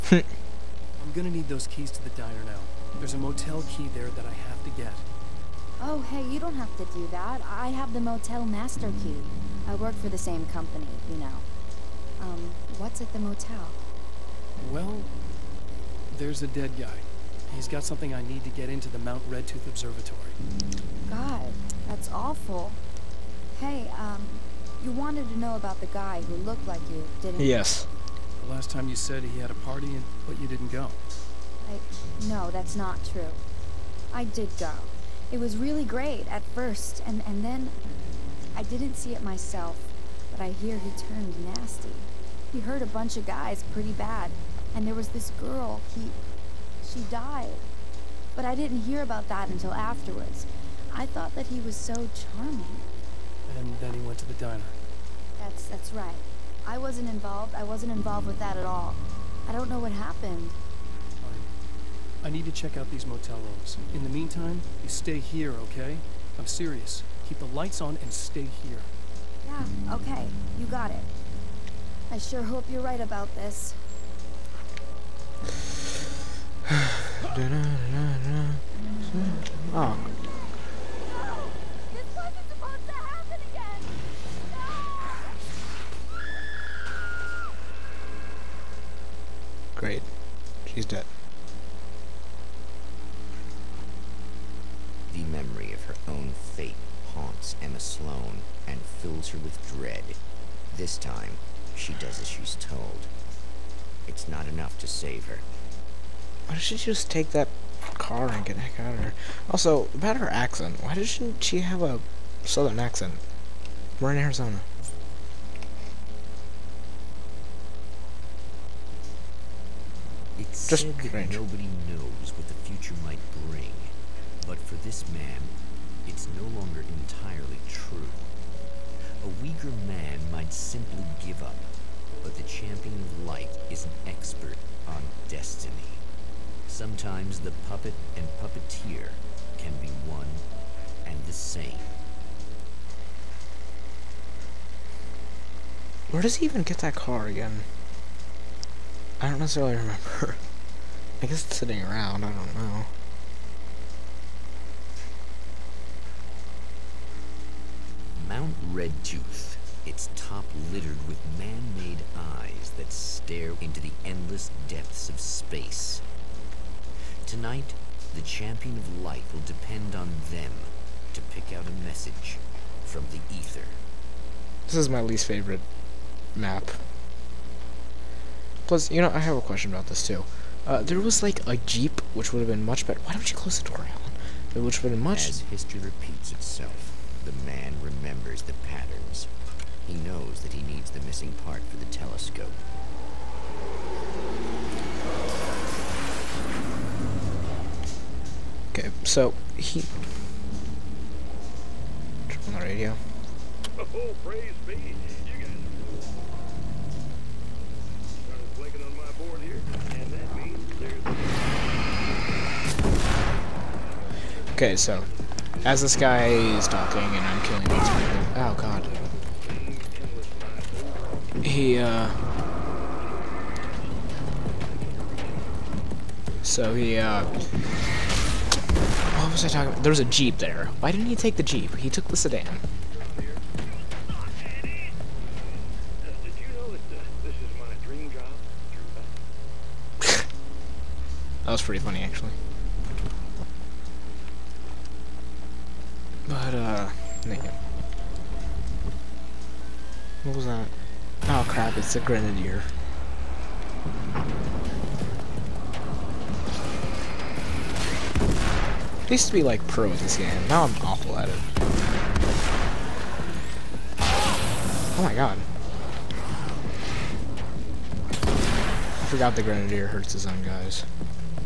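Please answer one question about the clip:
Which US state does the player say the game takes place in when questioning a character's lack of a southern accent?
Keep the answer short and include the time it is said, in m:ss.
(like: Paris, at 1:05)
Arizona, at 1:54.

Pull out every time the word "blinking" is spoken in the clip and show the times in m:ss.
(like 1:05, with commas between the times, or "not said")
3:28.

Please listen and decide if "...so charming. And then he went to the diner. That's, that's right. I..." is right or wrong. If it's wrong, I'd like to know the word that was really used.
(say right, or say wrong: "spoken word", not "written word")
right.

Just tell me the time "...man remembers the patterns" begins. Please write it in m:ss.
3:07.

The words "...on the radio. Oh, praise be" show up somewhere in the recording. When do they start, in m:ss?
3:22.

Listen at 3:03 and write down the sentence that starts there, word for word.
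Why don't you close the door, Alan?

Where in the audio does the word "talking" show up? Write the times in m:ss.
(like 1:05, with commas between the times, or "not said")
3:36, 3:49.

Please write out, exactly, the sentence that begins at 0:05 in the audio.
Oh, hey, you don't have to do that.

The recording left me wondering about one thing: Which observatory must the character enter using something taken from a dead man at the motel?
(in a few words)
Mount Redtooth Observatory.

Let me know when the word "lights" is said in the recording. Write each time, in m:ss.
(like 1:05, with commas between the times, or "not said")
1:07, 2:13, 2:49.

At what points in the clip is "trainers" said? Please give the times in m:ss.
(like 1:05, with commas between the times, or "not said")
not said.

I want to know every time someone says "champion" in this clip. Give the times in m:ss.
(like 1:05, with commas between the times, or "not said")
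2:12, 2:48.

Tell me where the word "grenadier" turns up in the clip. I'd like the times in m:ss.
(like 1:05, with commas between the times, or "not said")
4:12, 4:29.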